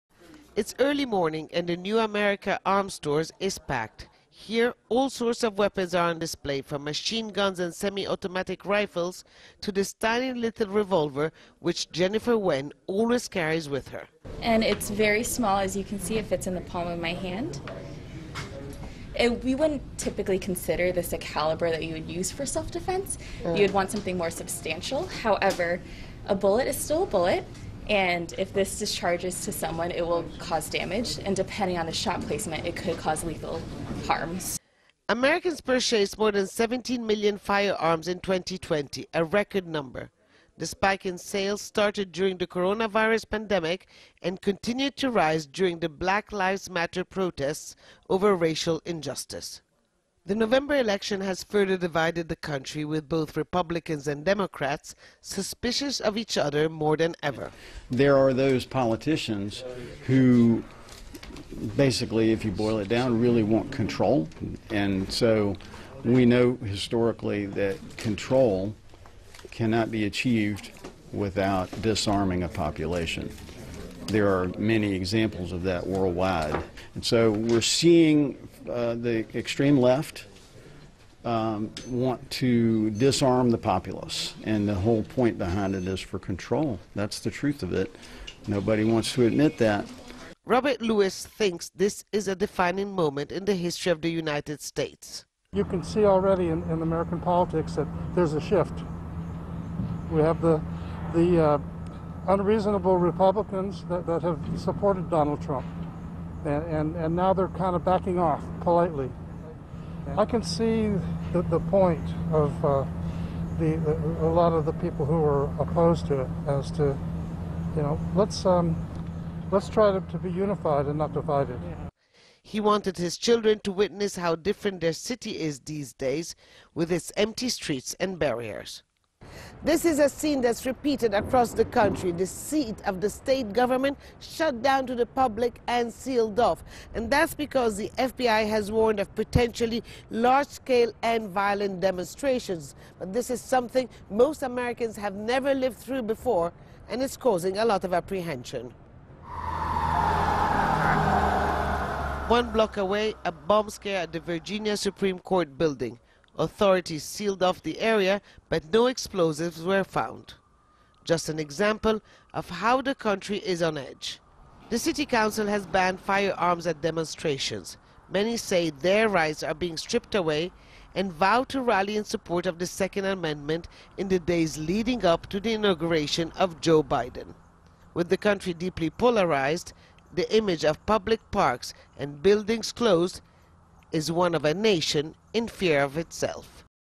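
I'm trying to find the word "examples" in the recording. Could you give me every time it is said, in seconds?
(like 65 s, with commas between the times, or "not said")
74 s, 161 s.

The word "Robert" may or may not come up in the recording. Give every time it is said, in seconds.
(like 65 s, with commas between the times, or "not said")
90 s.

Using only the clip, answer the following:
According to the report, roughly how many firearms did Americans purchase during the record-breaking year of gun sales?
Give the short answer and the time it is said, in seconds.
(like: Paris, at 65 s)
17 million, at 36 s.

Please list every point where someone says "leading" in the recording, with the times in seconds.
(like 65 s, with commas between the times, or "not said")
174 s.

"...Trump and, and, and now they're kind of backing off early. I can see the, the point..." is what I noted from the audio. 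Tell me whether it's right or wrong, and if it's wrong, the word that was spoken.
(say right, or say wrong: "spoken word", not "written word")
wrong: "politely", not "early".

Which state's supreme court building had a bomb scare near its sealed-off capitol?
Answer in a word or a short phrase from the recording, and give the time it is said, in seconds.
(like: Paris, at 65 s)
Virginia, at 154 s.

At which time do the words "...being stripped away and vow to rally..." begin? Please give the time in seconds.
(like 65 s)
169 s.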